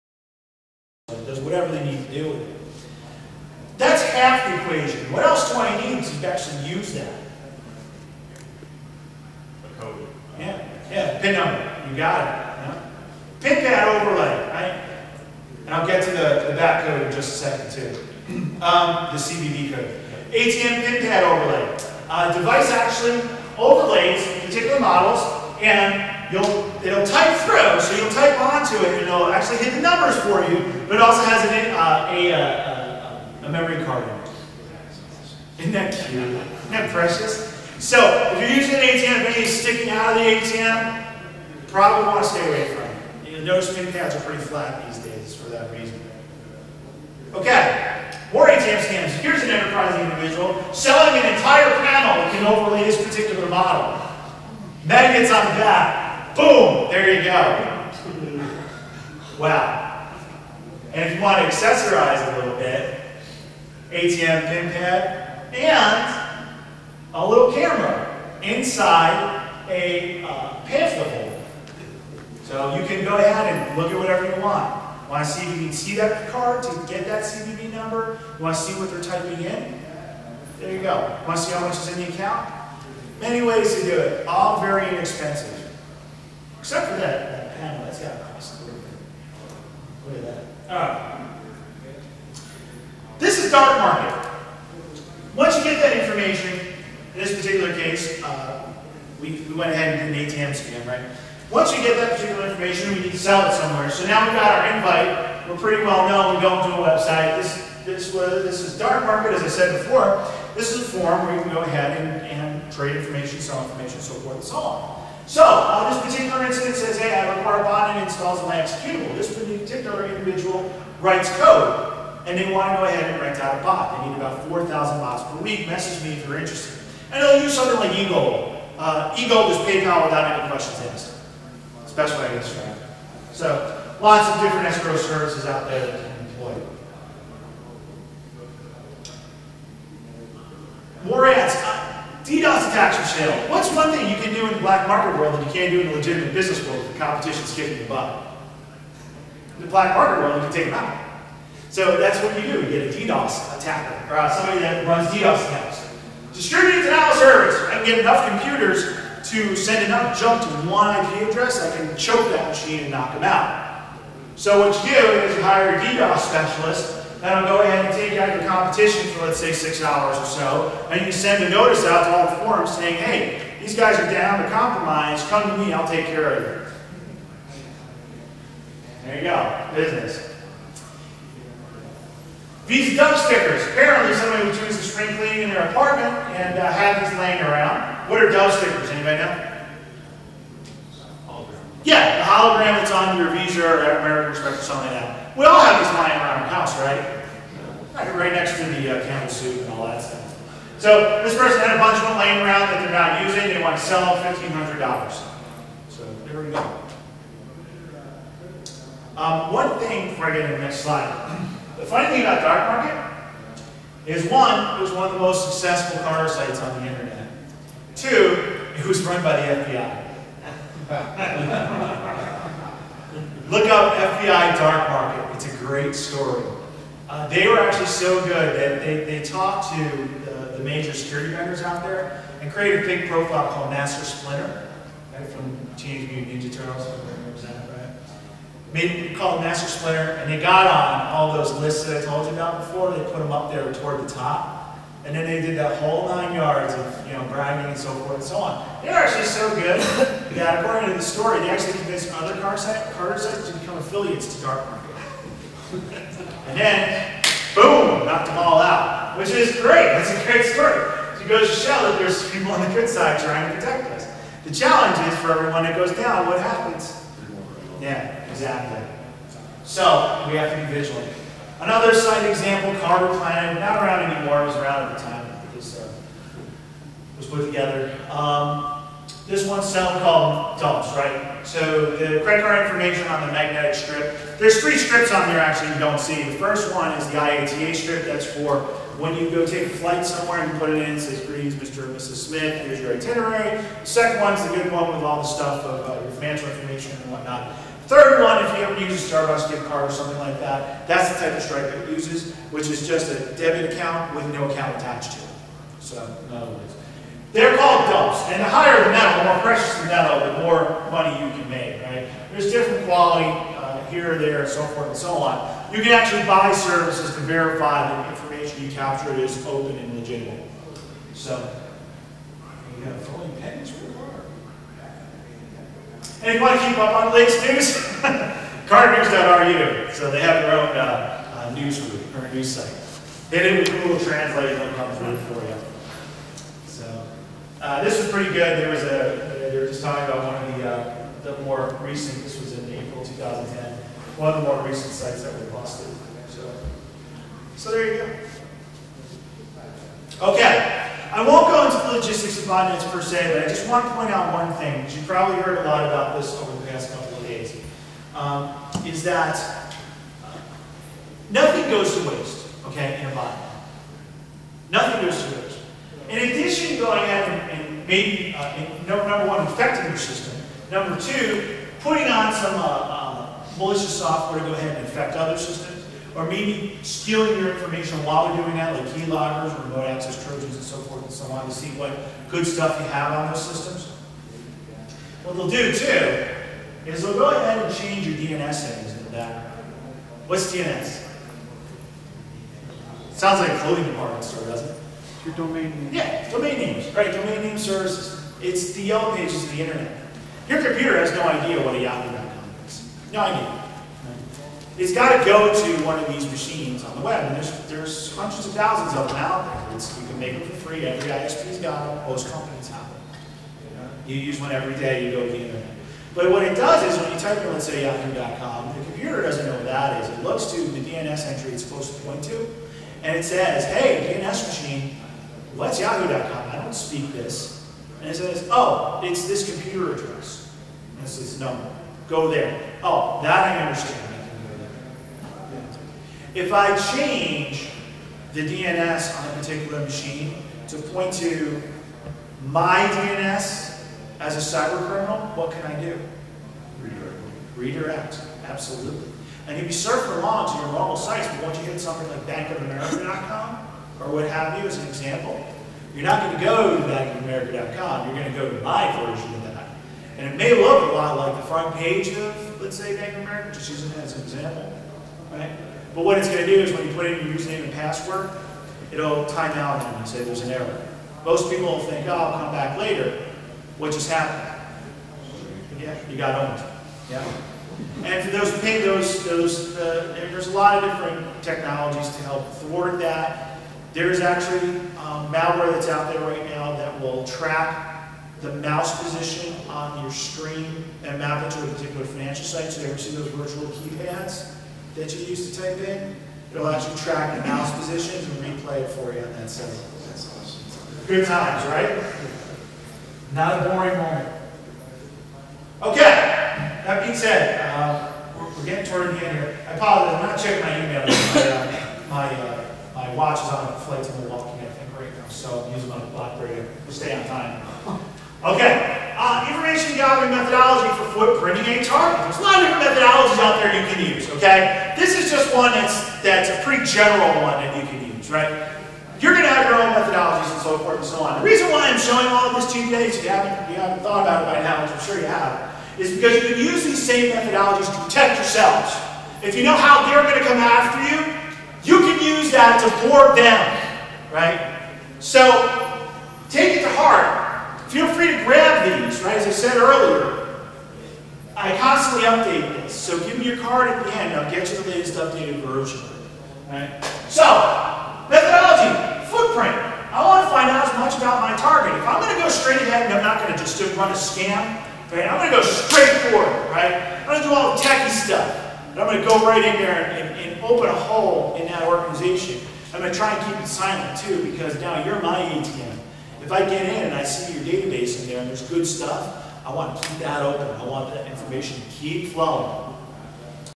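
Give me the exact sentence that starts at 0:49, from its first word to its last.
Here's an enterprising individual selling an entire panel that can overlay this particular model.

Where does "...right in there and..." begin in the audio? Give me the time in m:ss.
9:29.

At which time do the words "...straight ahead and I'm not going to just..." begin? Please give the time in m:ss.
9:22.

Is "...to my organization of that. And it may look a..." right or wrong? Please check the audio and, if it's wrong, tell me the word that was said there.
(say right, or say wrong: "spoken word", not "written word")
wrong: "version", not "organization".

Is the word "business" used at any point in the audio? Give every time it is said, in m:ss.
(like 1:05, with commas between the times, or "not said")
2:26, 2:59.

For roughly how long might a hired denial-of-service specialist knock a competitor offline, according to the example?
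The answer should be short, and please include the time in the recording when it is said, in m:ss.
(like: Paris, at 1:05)
6 hours, at 2:49.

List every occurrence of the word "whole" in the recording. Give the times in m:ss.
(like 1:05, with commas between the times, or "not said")
4:05.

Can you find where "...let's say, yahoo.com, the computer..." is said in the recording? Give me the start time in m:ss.
6:57.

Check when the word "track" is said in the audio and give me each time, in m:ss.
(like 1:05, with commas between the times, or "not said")
8:07, 8:16.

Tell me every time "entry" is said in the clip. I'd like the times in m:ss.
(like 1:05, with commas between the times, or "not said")
7:01.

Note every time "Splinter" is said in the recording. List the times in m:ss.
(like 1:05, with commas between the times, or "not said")
3:54, 3:59.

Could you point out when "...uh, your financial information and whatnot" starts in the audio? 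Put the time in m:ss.
4:55.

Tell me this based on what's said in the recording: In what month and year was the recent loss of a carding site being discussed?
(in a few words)
April 2010.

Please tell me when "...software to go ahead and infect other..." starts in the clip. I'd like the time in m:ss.
6:13.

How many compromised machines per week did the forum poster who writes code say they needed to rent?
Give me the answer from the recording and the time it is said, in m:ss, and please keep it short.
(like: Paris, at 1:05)
4,000, at 2:04.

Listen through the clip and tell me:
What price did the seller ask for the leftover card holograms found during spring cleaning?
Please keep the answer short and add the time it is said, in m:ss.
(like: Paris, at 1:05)
$1,500, at 3:24.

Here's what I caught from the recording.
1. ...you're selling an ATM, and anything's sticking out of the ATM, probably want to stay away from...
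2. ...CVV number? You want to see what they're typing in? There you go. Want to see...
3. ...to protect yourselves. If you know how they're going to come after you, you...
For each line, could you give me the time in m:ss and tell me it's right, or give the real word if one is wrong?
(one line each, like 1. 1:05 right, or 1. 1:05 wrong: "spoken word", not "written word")
1. 0:38 wrong: "using", not "selling"
2. 1:17 right
3. 8:57 right.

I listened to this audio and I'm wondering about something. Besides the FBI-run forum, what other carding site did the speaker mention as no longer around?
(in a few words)
Carder Planet.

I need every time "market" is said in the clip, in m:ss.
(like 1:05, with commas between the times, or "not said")
1:33, 1:49, 2:24, 2:29, 3:32, 3:44, 4:14.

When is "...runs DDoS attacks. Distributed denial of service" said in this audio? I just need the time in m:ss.
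2:34.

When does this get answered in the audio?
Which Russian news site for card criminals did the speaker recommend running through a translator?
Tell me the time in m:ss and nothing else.
5:28.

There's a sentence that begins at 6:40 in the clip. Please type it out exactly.
Your computer has no idea what a Yahoo.com is.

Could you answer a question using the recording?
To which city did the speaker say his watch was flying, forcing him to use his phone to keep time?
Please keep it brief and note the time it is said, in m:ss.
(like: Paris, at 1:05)
Milwaukee, at 8:34.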